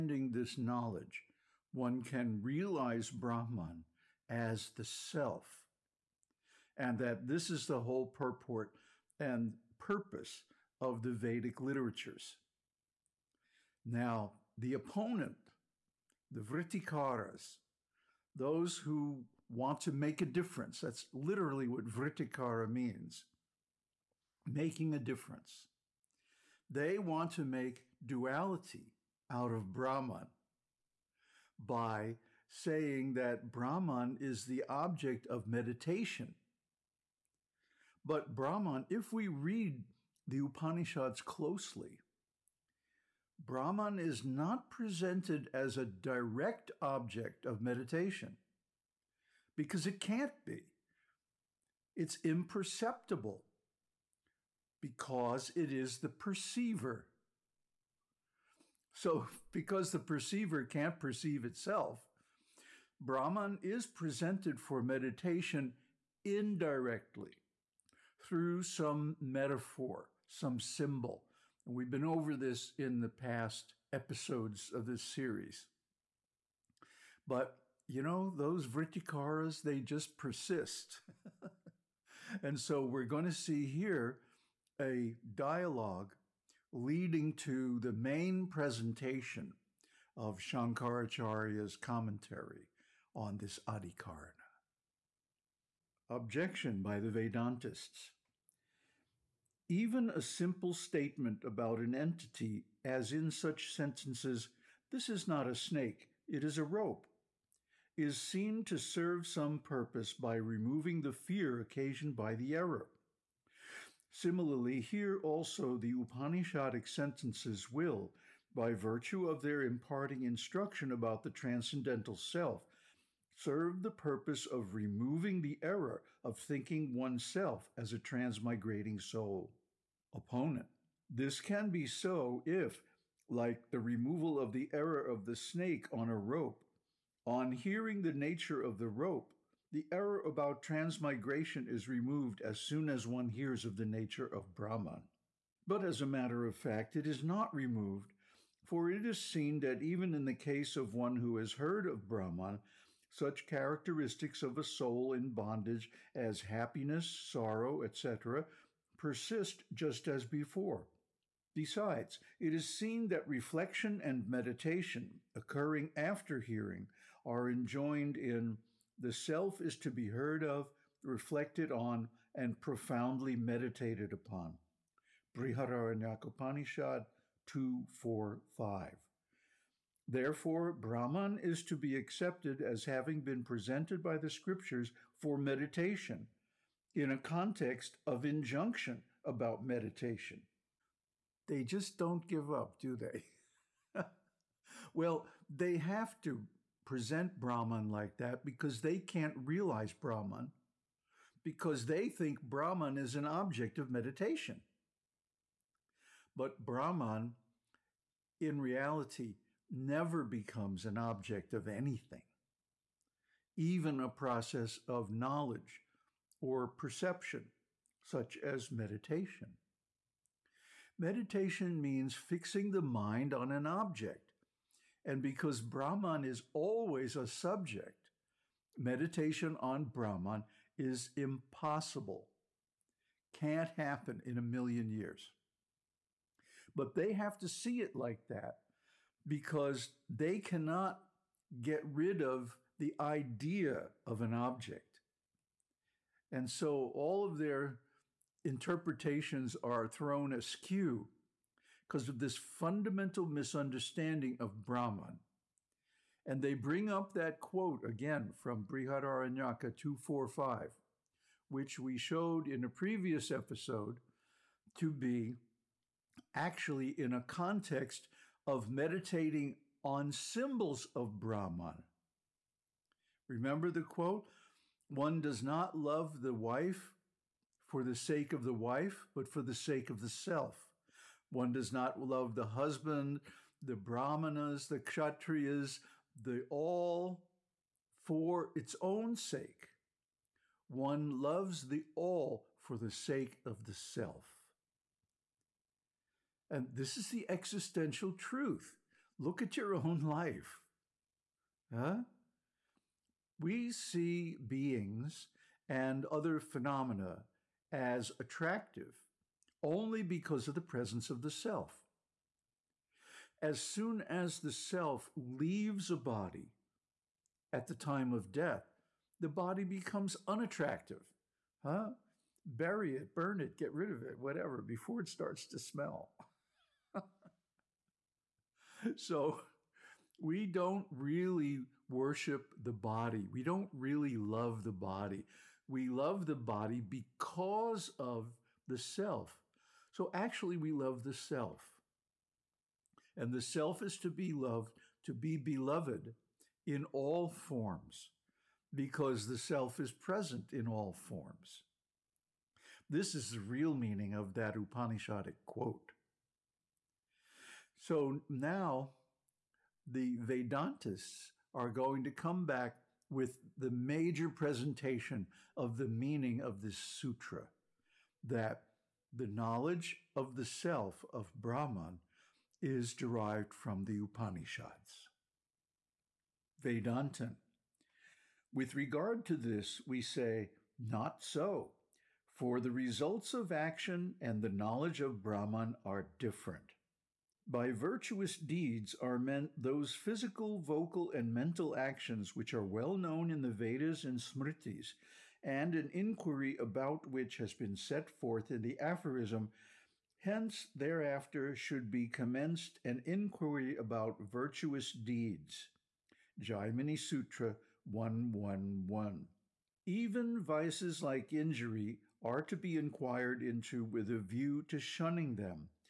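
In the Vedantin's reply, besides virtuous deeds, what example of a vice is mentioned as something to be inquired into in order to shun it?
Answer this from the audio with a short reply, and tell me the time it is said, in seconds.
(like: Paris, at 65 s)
Injury, at 411 s.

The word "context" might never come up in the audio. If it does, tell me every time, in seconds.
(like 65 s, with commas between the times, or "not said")
187 s, 267 s.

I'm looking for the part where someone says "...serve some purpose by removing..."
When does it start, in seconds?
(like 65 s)
108 s.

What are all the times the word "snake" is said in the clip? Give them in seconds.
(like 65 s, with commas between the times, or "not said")
105 s, 135 s.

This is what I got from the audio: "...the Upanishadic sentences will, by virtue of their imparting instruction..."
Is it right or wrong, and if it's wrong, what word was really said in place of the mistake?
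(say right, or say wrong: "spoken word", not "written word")
right.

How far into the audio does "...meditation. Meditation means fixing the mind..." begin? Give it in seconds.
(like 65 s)
218 s.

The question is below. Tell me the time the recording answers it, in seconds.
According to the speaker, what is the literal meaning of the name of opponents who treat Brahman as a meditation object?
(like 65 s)
24 s.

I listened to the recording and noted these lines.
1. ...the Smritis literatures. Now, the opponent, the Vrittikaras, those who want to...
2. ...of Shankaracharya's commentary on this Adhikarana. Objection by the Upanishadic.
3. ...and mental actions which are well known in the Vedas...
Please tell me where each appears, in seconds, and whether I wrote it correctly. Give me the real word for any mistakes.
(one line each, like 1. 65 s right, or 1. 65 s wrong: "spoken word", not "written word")
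1. 11 s wrong: "Vedic", not "Smritis"
2. 90 s wrong: "Vedantists", not "Upanishadic"
3. 391 s right.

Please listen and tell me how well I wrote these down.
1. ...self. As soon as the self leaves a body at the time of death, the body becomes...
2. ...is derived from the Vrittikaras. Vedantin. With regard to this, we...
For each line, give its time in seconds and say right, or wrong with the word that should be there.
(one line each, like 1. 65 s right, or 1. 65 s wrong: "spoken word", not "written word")
1. 311 s right
2. 372 s wrong: "Upanishads", not "Vrittikaras".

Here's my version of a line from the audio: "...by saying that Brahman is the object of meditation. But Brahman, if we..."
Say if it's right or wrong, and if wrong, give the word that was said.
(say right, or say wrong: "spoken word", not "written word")
right.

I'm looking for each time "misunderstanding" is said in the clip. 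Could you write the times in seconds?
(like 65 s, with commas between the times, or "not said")
253 s.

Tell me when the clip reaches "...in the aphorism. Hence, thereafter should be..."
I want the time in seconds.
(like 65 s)
398 s.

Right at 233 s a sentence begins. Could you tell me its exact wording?
Can't happen in a million years.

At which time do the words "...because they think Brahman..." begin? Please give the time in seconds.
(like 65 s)
201 s.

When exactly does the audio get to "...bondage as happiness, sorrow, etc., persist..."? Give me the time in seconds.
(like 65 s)
155 s.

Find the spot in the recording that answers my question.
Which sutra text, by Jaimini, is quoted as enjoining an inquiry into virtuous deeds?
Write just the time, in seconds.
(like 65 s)
406 s.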